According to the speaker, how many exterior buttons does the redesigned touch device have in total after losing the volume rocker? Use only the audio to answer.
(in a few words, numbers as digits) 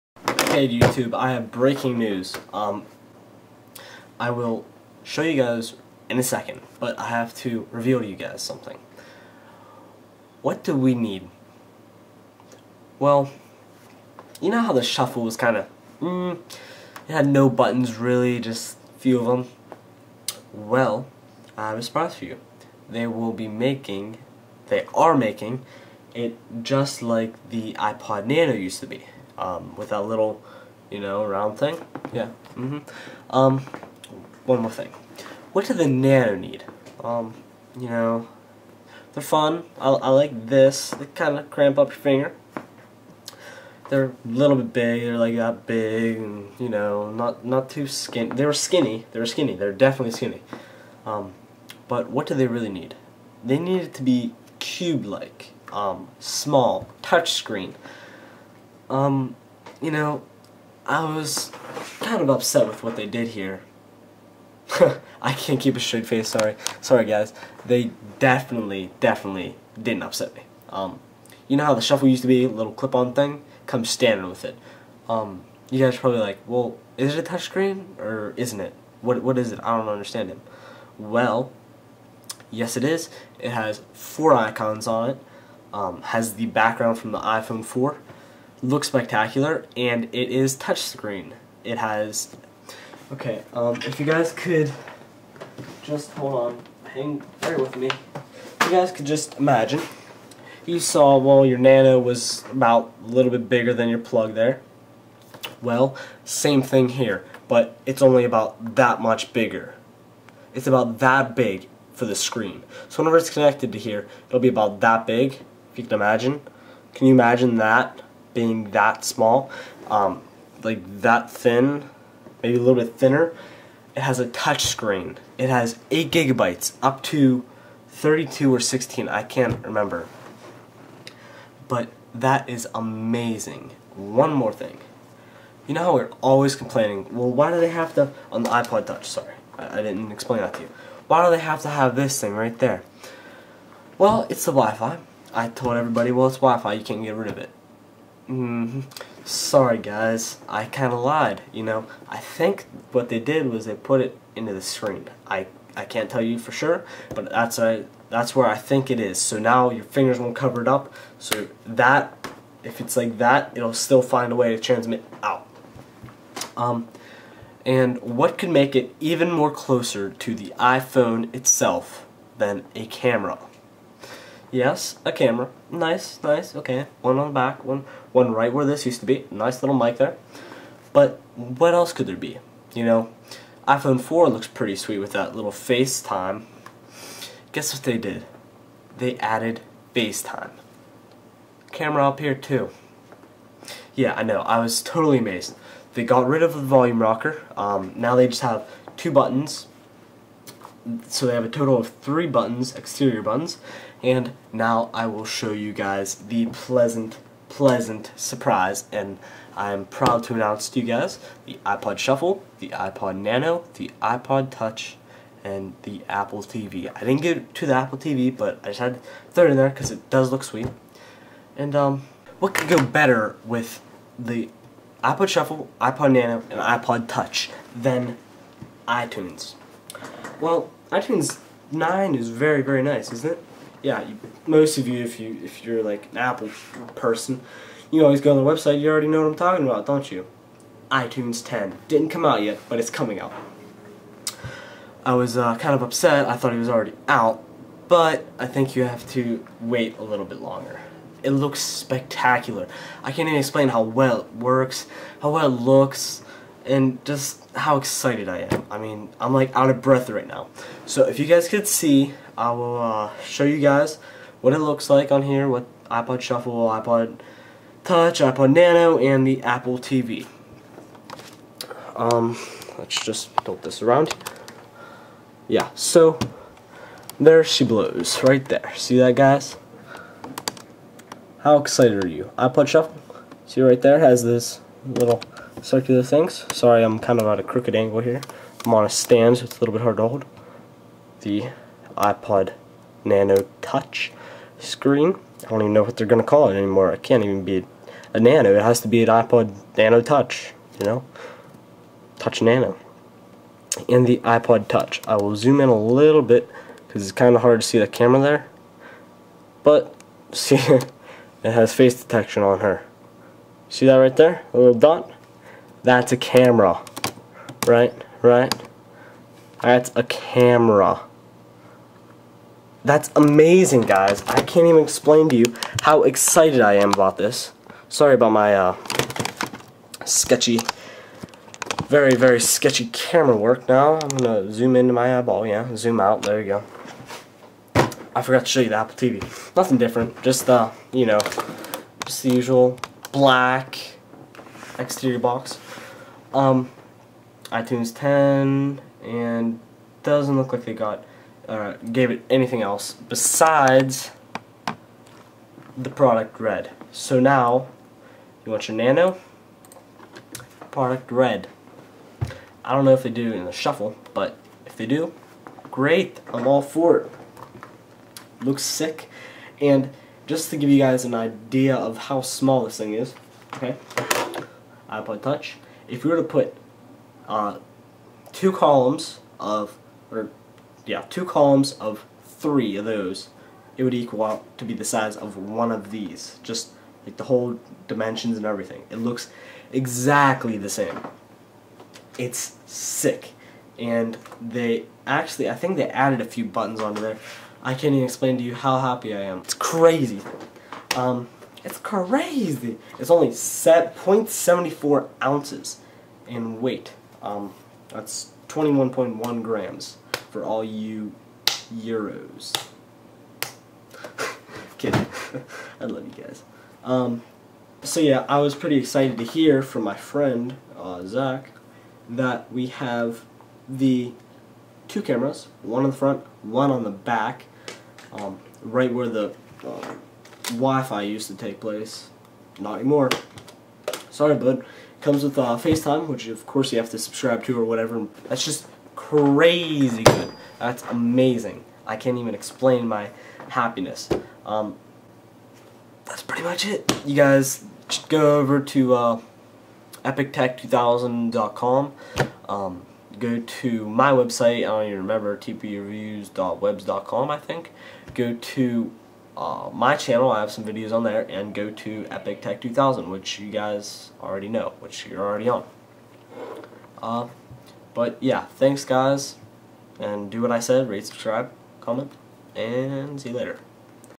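3.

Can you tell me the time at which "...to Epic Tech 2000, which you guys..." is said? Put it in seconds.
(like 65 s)
461 s.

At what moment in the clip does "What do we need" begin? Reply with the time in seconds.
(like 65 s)
10 s.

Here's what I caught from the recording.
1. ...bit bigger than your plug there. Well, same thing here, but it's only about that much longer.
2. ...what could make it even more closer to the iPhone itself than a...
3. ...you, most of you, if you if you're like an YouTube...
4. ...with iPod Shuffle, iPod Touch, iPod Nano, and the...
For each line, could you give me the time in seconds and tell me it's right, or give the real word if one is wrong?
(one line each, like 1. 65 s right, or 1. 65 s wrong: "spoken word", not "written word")
1. 103 s wrong: "bigger", not "longer"
2. 168 s right
3. 234 s wrong: "Apple", not "YouTube"
4. 265 s right.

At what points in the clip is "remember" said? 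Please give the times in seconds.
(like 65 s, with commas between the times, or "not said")
129 s, 454 s.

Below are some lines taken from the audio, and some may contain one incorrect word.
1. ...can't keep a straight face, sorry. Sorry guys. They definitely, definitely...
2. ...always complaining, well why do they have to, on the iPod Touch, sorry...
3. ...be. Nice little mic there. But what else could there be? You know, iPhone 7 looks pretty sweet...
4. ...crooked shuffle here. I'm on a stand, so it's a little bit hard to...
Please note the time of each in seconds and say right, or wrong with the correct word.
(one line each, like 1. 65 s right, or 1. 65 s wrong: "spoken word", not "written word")
1. 65 s right
2. 136 s right
3. 179 s wrong: "4", not "7"
4. 287 s wrong: "angle", not "shuffle".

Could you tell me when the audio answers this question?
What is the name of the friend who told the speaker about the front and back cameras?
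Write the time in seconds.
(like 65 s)
421 s.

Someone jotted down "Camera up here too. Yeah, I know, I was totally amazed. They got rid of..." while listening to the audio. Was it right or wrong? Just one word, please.
right.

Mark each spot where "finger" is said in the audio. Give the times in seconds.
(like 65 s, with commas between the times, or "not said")
41 s, 159 s.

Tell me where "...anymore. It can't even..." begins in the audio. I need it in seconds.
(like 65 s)
296 s.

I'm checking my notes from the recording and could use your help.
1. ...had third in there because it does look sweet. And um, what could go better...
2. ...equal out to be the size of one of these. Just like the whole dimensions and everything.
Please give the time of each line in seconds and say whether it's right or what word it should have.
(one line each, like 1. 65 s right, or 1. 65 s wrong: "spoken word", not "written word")
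1. 218 s right
2. 383 s right.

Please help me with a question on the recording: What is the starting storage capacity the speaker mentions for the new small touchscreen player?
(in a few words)
8 gigabytes.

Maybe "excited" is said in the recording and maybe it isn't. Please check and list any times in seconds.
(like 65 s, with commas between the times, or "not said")
257 s, 281 s, 326 s, 418 s.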